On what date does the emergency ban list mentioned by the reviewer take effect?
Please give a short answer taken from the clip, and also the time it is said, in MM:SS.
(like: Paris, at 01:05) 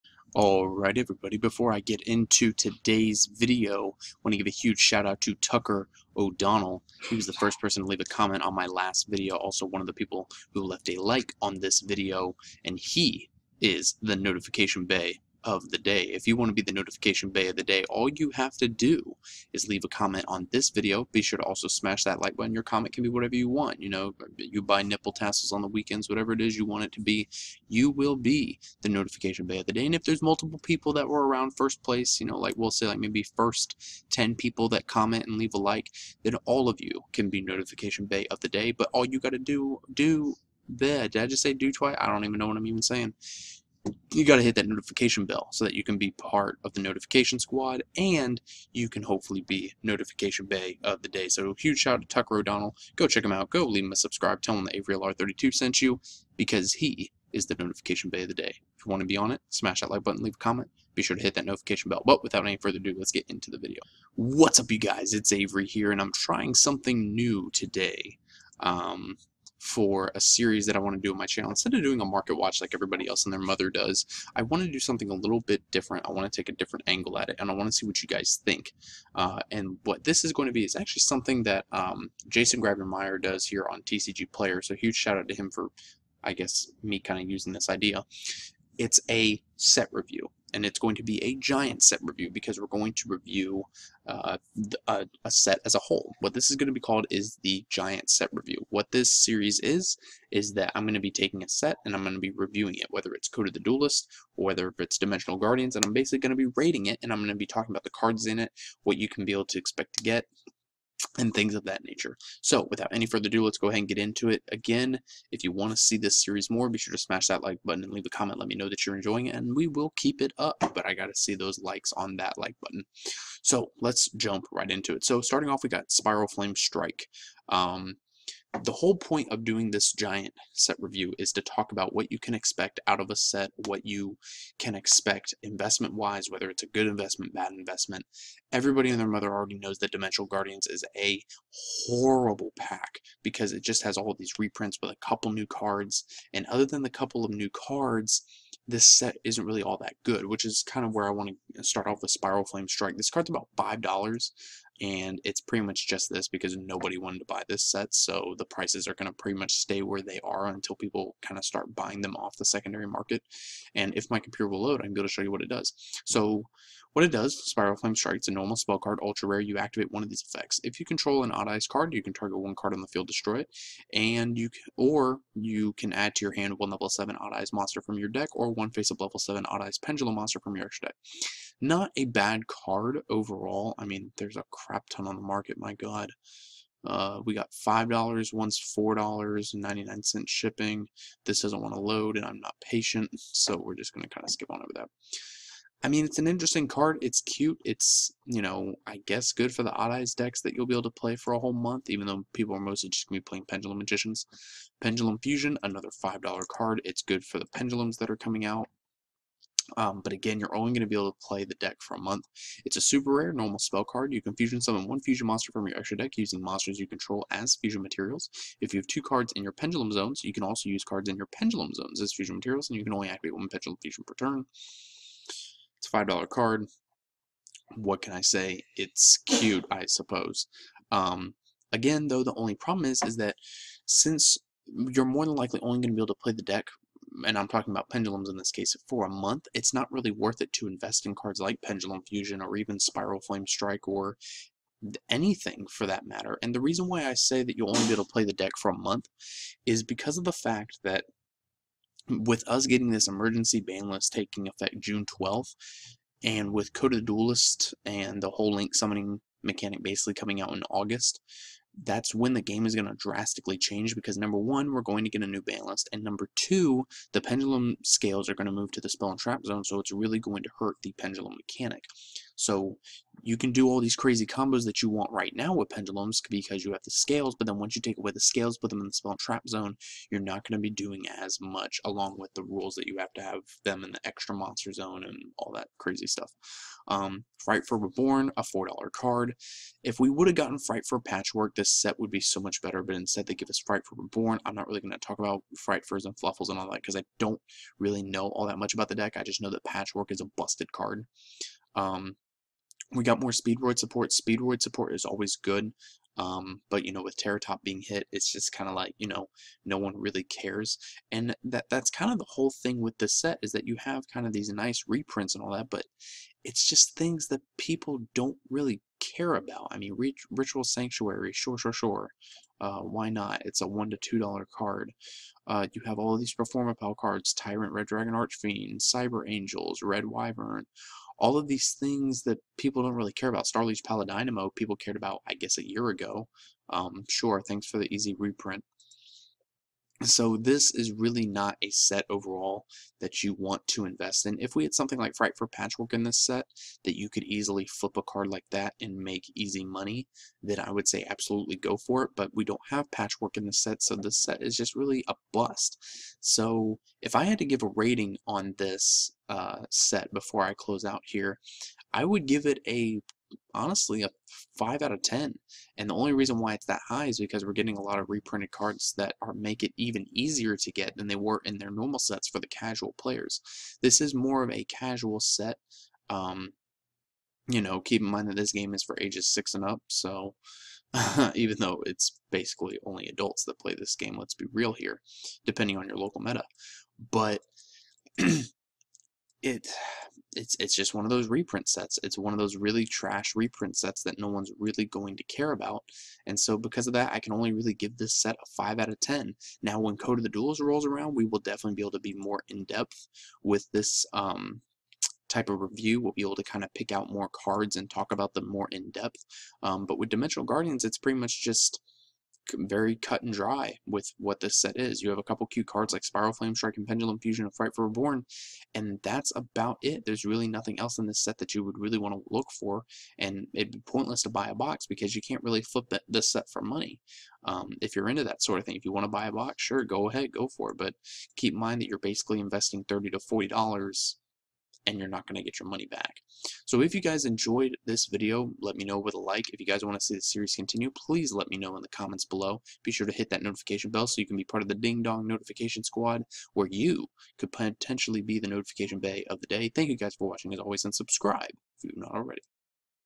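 June 12th, at 04:14.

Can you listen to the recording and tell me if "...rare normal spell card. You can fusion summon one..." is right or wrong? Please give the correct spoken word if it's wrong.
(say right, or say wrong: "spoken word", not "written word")
right.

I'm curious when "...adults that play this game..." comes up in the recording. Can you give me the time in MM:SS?
06:23.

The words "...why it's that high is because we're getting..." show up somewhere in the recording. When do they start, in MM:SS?
06:06.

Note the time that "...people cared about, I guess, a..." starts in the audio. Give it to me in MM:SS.
05:34.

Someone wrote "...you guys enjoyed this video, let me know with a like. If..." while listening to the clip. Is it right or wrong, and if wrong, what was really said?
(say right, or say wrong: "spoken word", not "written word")
right.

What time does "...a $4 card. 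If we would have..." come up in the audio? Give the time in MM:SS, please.
04:48.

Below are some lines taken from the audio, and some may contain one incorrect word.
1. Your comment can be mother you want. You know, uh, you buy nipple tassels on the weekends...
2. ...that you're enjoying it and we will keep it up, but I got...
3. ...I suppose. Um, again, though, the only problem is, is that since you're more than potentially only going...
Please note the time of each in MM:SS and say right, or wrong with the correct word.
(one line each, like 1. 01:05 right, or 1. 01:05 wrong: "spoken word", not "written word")
1. 00:22 wrong: "whatever", not "mother"
2. 01:58 right
3. 03:49 wrong: "likely", not "potentially".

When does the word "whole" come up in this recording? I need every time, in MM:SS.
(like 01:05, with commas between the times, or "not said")
01:35, 02:08, 03:21, 04:18, 05:12.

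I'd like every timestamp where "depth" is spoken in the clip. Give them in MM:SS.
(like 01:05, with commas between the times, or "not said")
06:42, 06:48.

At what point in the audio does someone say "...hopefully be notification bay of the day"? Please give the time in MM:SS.
00:49.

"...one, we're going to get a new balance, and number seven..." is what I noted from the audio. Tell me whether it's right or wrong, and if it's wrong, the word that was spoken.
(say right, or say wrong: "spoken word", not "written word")
wrong: "two", not "seven".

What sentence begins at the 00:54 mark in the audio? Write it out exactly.
Tell him that Avery LR32 sent you because he is the notification bay of the day.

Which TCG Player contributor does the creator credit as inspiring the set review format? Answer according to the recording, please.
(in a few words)
Jason Grabher-Meyer.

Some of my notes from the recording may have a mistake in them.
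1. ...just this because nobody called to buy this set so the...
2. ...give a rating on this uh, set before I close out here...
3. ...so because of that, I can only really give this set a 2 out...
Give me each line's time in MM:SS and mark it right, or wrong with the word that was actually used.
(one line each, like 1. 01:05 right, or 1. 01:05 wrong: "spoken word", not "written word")
1. 02:35 wrong: "wanted", not "called"
2. 05:57 right
3. 06:36 wrong: "5", not "2".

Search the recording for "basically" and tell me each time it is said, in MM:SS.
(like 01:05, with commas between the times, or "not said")
01:45, 04:19, 06:22, 07:11.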